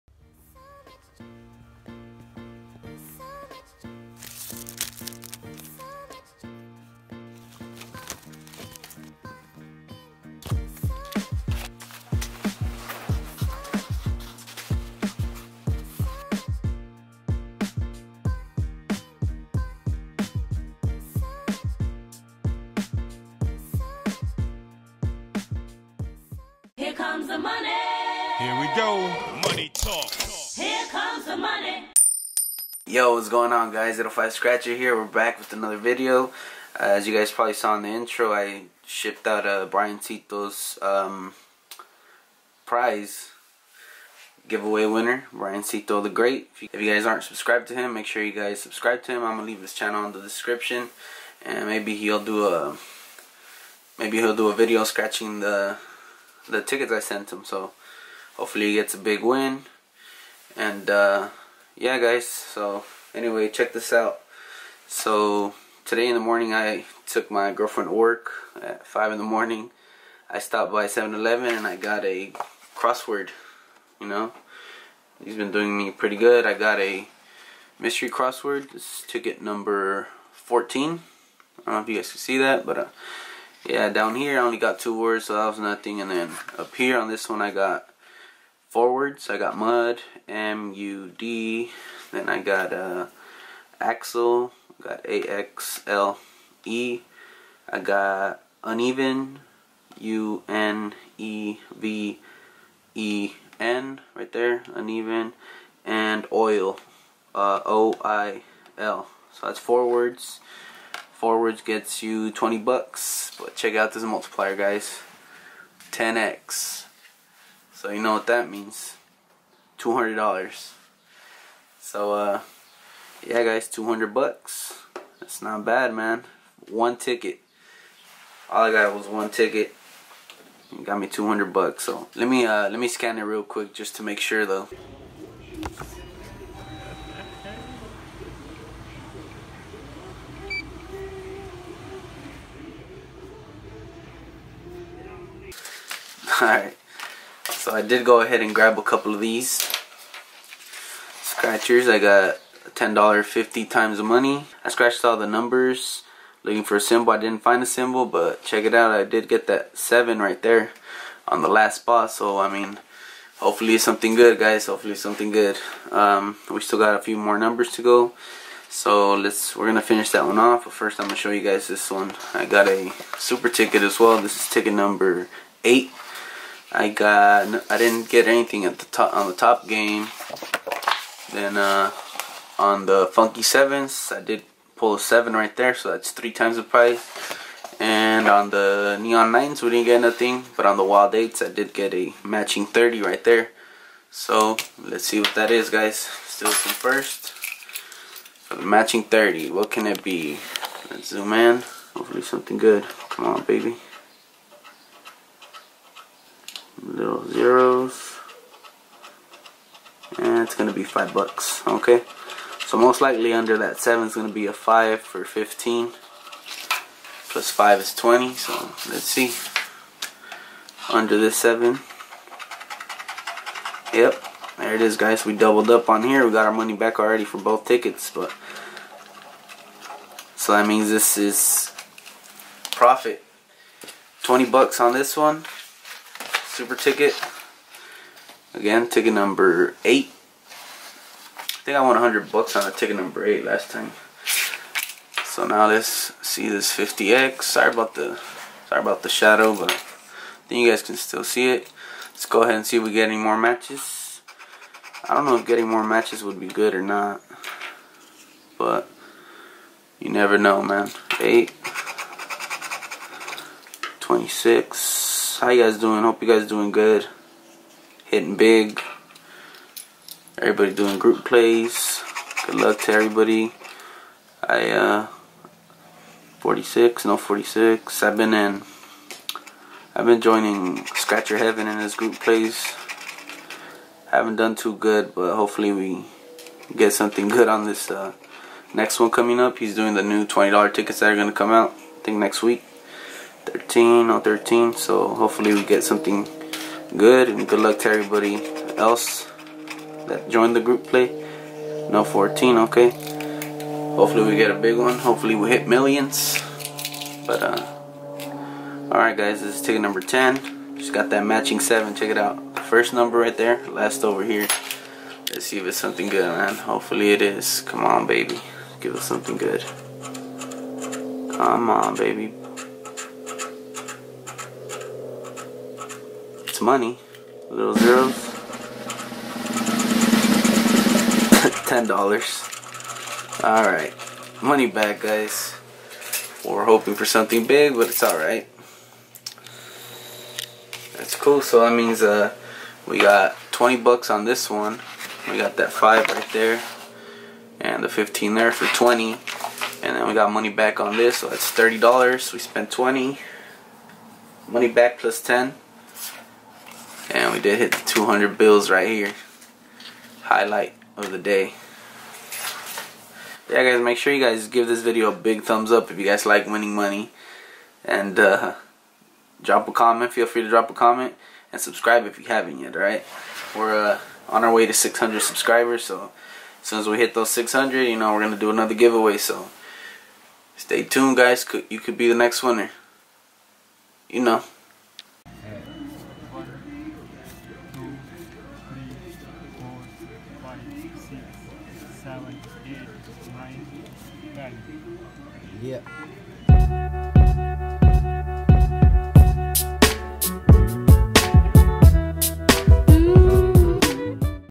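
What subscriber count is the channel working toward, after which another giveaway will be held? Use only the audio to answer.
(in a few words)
600.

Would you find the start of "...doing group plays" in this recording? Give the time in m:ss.
4:30.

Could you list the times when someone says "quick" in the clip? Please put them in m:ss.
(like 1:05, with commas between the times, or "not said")
2:13.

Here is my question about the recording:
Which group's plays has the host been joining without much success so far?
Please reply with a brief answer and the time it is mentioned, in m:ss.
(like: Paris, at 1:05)
Scratcher Heaven, at 4:40.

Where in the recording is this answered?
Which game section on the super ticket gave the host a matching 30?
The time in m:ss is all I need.
3:10.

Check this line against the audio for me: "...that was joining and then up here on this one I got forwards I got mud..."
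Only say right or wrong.
wrong.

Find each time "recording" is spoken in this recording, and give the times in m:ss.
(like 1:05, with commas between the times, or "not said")
not said.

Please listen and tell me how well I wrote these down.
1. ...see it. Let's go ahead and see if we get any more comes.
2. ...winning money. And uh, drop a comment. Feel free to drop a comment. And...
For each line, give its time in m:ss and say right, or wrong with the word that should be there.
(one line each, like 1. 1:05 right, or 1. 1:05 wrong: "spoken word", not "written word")
1. 4:11 wrong: "matches", not "comes"
2. 6:06 right.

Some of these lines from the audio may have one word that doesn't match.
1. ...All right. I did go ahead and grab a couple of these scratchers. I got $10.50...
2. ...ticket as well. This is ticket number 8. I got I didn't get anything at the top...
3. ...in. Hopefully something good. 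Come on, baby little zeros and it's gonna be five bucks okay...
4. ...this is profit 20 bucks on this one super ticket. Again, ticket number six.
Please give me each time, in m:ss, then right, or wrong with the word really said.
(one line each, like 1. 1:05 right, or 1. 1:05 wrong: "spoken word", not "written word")
1. 2:26 right
2. 2:53 right
3. 3:21 right
4. 3:50 wrong: "eight", not "six".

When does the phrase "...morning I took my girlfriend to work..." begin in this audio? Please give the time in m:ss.
1:06.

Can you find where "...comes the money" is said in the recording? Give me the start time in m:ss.
0:30.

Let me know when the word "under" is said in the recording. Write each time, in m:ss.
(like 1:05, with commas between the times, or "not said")
3:33, 3:40.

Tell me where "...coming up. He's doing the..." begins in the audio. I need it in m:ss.
4:49.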